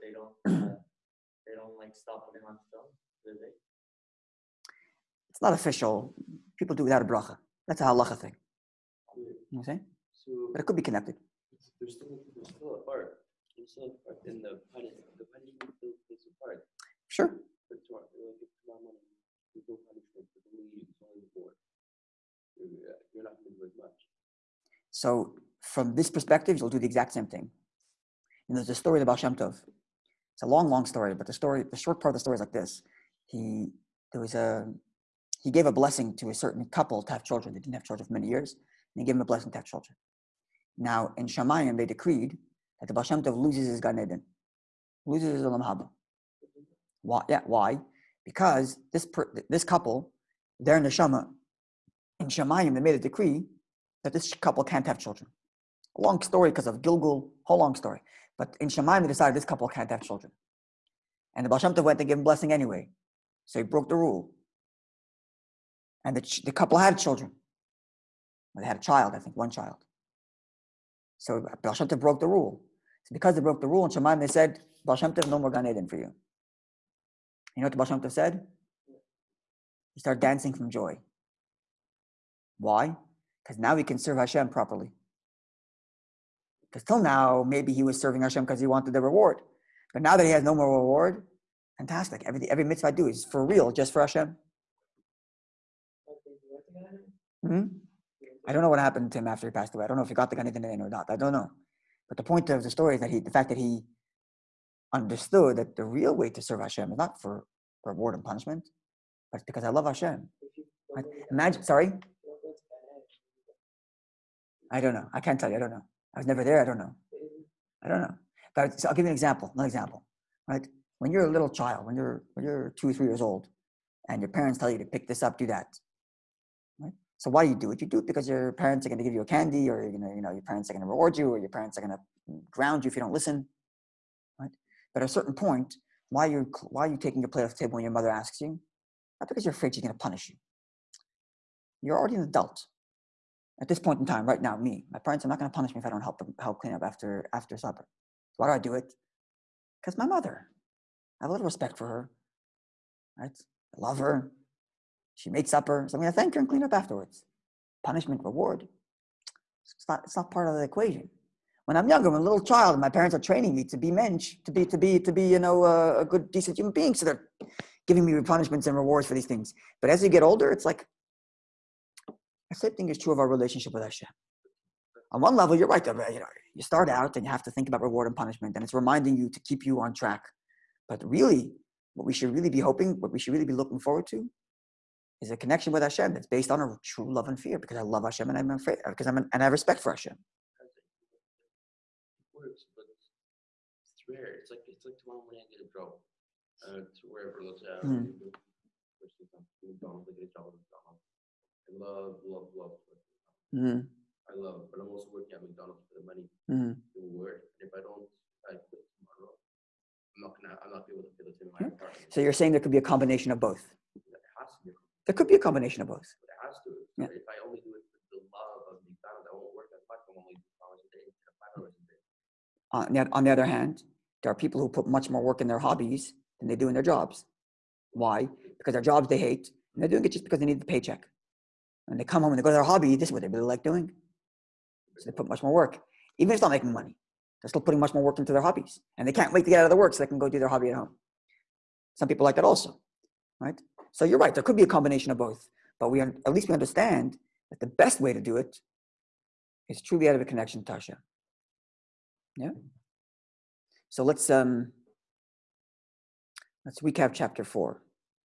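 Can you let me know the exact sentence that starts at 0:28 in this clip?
And there's a story about Shem Tov.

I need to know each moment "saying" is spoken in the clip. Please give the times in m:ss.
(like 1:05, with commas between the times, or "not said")
0:09, 3:32.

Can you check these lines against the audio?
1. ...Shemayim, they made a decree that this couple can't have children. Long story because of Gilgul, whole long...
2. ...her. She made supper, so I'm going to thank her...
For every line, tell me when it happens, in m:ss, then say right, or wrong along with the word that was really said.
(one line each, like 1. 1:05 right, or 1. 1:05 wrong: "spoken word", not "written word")
1. 0:52 right
2. 2:33 right.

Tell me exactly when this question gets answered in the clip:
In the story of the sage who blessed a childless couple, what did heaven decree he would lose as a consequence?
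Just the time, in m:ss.
0:45.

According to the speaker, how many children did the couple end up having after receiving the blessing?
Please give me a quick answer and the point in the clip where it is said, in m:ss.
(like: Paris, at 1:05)
1, at 1:09.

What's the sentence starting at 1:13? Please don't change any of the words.
So because they broke the rule in Shemayim, they said, Baal Shem Tov, no more Gan Eden for you.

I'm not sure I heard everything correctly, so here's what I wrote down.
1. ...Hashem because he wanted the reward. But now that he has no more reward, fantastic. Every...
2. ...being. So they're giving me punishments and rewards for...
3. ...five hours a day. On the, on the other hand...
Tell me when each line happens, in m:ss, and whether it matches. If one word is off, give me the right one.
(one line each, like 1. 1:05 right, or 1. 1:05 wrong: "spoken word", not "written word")
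1. 1:28 right
2. 2:46 right
3. 3:41 right.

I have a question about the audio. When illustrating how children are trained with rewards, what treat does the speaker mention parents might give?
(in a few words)
A candy.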